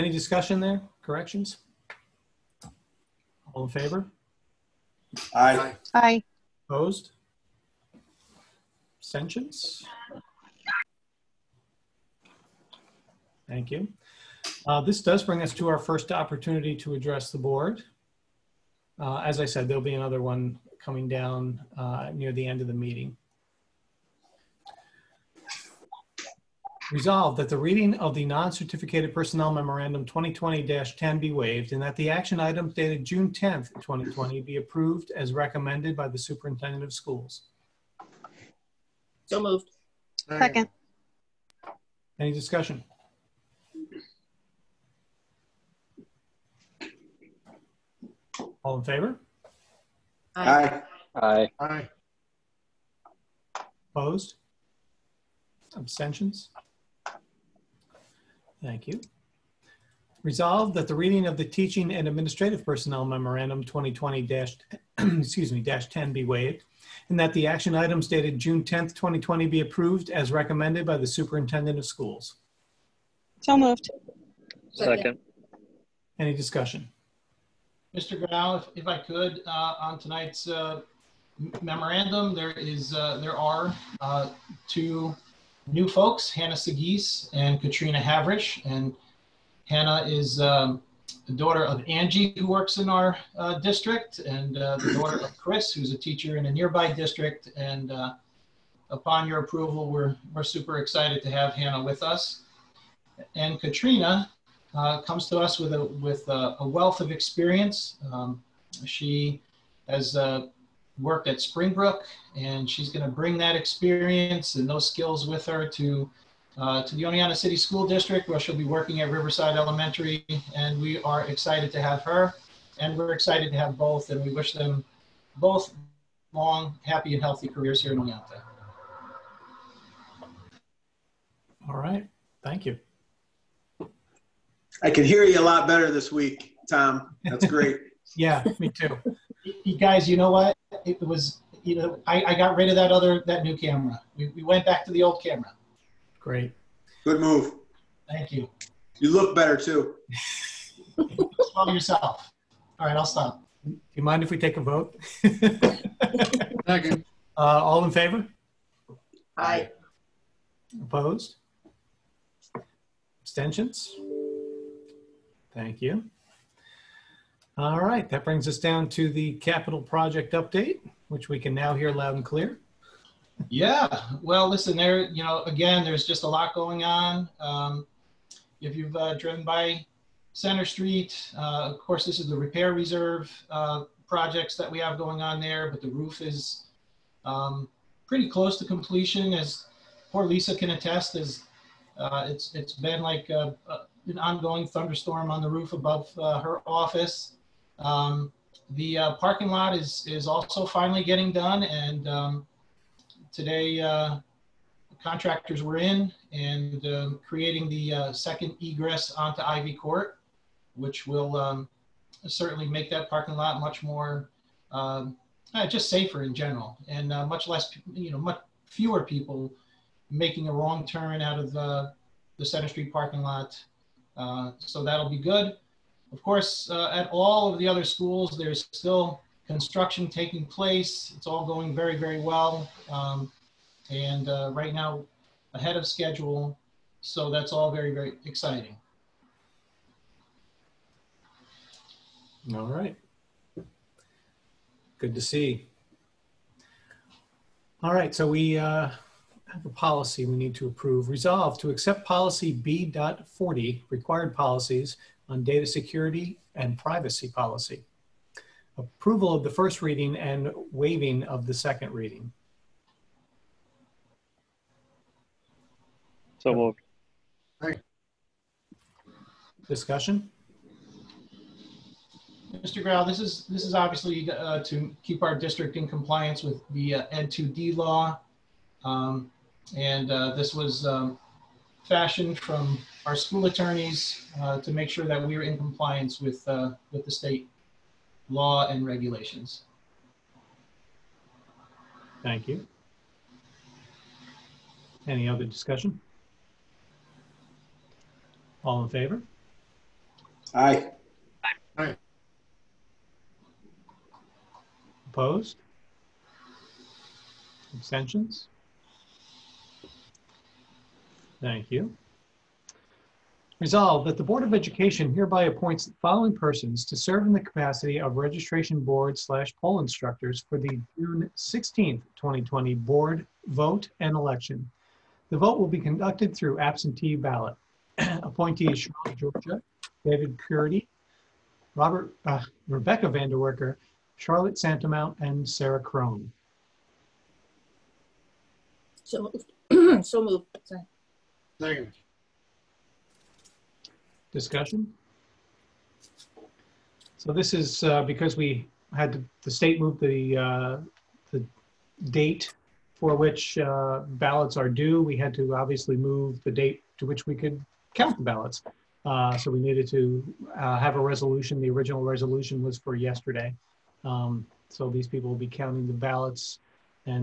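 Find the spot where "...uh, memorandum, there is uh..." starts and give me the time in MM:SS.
01:20.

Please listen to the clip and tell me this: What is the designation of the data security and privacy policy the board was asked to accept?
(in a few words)
B.40.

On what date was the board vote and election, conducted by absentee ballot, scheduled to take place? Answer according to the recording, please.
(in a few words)
June 16th, 2020.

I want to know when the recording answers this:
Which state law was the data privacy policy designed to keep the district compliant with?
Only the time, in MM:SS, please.
04:37.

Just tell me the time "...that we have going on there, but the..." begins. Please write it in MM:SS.
03:04.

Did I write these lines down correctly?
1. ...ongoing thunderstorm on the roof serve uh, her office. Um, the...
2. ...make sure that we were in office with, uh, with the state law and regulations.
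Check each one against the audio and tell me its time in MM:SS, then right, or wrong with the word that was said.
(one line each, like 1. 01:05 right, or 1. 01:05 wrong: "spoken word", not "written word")
1. 03:14 wrong: "above", not "serve"
2. 04:44 wrong: "compliance", not "office".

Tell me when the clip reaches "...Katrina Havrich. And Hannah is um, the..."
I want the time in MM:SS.
01:27.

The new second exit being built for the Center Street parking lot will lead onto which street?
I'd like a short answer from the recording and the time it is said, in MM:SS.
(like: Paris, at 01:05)
Ivy Court, at 03:29.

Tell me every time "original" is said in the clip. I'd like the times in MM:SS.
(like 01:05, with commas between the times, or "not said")
06:01.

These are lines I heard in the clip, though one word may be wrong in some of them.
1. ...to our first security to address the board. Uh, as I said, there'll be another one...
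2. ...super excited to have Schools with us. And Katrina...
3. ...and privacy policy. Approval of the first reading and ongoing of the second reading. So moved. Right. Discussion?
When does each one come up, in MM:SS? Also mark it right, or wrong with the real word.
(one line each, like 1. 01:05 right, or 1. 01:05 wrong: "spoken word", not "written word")
1. 00:15 wrong: "opportunity", not "security"
2. 01:40 wrong: "Hannah", not "Schools"
3. 04:16 wrong: "waiving", not "ongoing".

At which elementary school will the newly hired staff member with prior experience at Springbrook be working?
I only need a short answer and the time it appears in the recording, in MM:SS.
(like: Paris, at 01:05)
Riverside Elementary, at 01:59.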